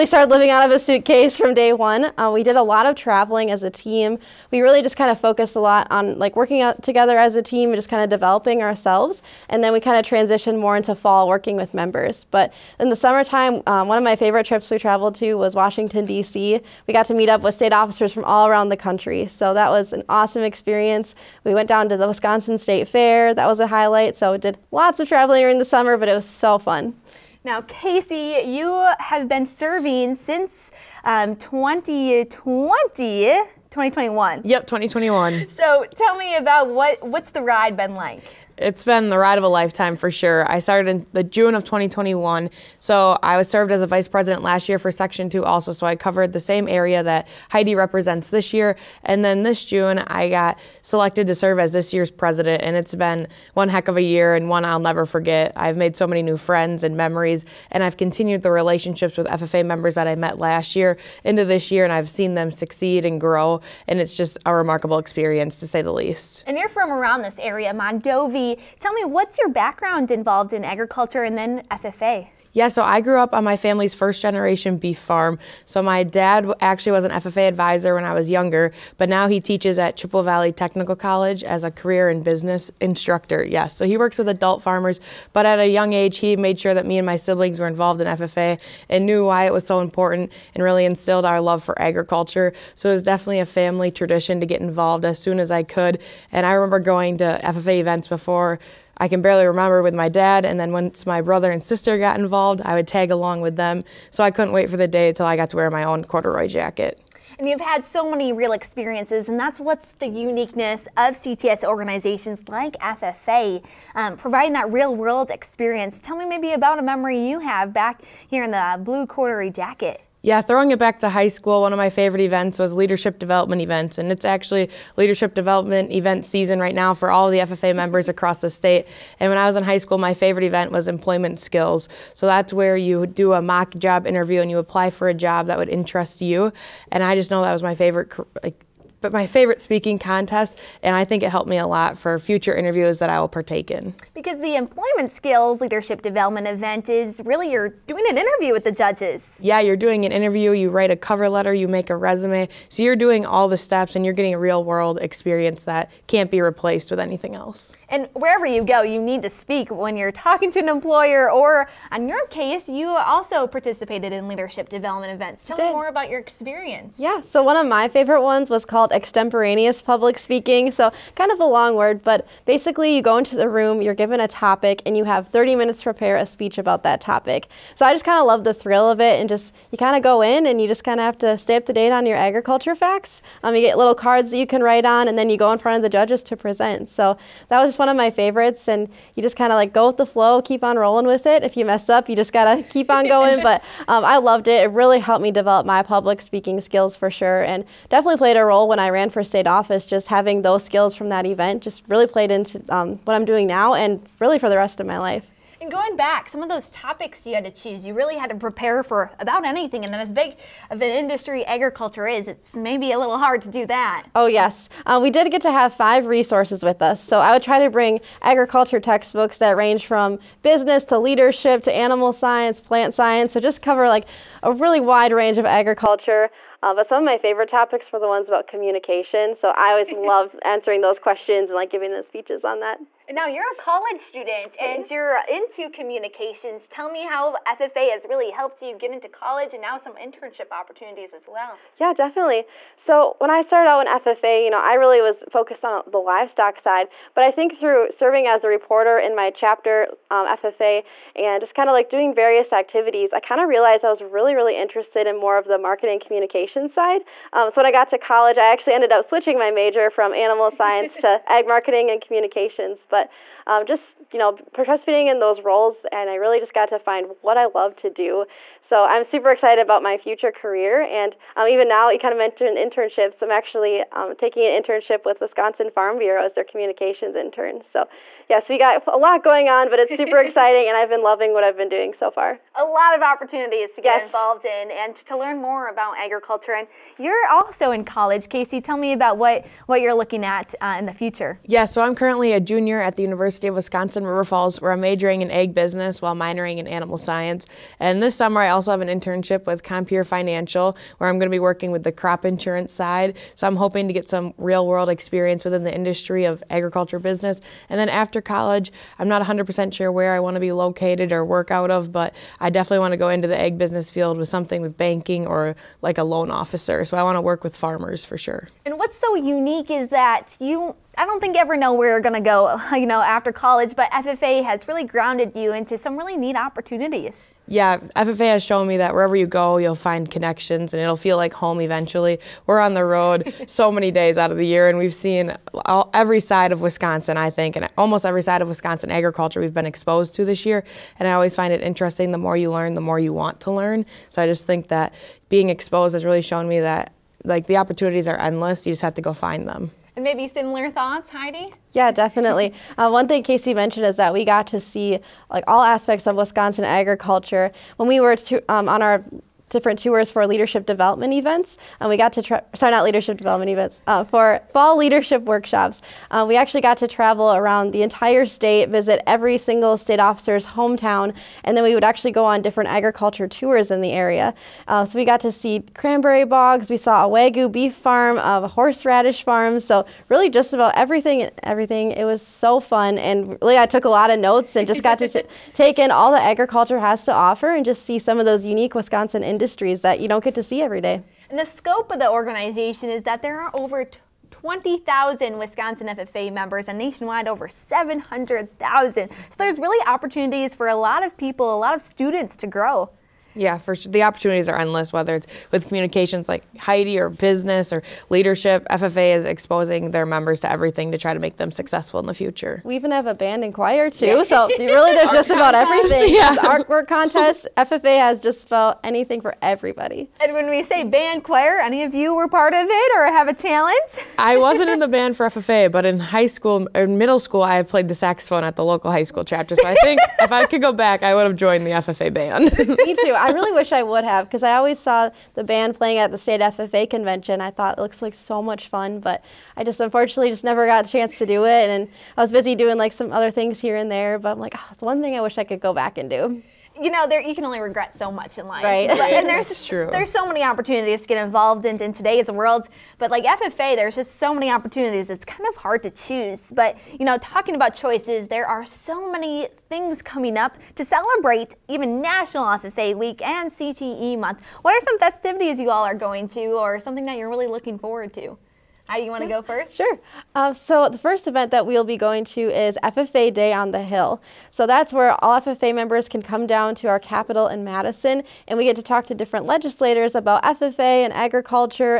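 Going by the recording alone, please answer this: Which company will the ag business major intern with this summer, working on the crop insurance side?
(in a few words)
Compeer Financial.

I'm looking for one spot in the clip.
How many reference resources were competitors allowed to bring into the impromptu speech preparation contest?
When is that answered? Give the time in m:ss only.
3:35.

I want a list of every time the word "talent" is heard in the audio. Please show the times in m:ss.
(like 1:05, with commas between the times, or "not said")
7:03.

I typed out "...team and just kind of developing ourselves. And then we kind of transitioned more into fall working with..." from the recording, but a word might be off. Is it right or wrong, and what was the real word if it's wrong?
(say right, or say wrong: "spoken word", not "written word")
right.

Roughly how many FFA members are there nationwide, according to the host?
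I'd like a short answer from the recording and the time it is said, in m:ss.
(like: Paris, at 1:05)
700,000, at 6:37.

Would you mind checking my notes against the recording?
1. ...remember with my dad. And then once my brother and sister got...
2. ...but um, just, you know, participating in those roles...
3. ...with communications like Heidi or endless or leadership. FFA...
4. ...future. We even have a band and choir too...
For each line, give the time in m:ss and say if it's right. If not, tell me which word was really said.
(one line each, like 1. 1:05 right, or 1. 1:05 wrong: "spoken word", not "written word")
1. 1:39 right
2. 4:22 right
3. 6:45 wrong: "business", not "endless"
4. 6:52 right.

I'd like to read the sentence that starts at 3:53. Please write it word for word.
Now you're a college student and you're into communications.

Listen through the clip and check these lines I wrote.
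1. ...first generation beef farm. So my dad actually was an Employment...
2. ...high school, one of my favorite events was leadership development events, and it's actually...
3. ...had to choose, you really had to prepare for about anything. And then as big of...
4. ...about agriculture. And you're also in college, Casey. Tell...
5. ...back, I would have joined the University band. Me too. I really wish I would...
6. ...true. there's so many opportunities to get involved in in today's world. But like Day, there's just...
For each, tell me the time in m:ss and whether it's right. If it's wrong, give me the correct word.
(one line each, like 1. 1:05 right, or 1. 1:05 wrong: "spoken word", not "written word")
1. 1:13 wrong: "FFA", not "Employment"
2. 2:01 right
3. 3:27 right
4. 4:45 right
5. 7:10 wrong: "FFA", not "University"
6. 7:29 wrong: "FFA", not "Day".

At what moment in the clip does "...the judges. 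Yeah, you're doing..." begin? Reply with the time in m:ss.
2:28.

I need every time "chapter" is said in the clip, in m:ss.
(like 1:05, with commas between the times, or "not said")
4:09, 7:09.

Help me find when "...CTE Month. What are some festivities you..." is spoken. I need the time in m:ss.
7:43.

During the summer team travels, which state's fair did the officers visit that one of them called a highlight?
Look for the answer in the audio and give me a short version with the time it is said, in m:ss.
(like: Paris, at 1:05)
Wisconsin State Fair, at 0:22.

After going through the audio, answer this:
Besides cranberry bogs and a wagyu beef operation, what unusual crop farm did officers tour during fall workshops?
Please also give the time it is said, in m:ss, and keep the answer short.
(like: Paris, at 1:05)
Horseradish farm, at 6:18.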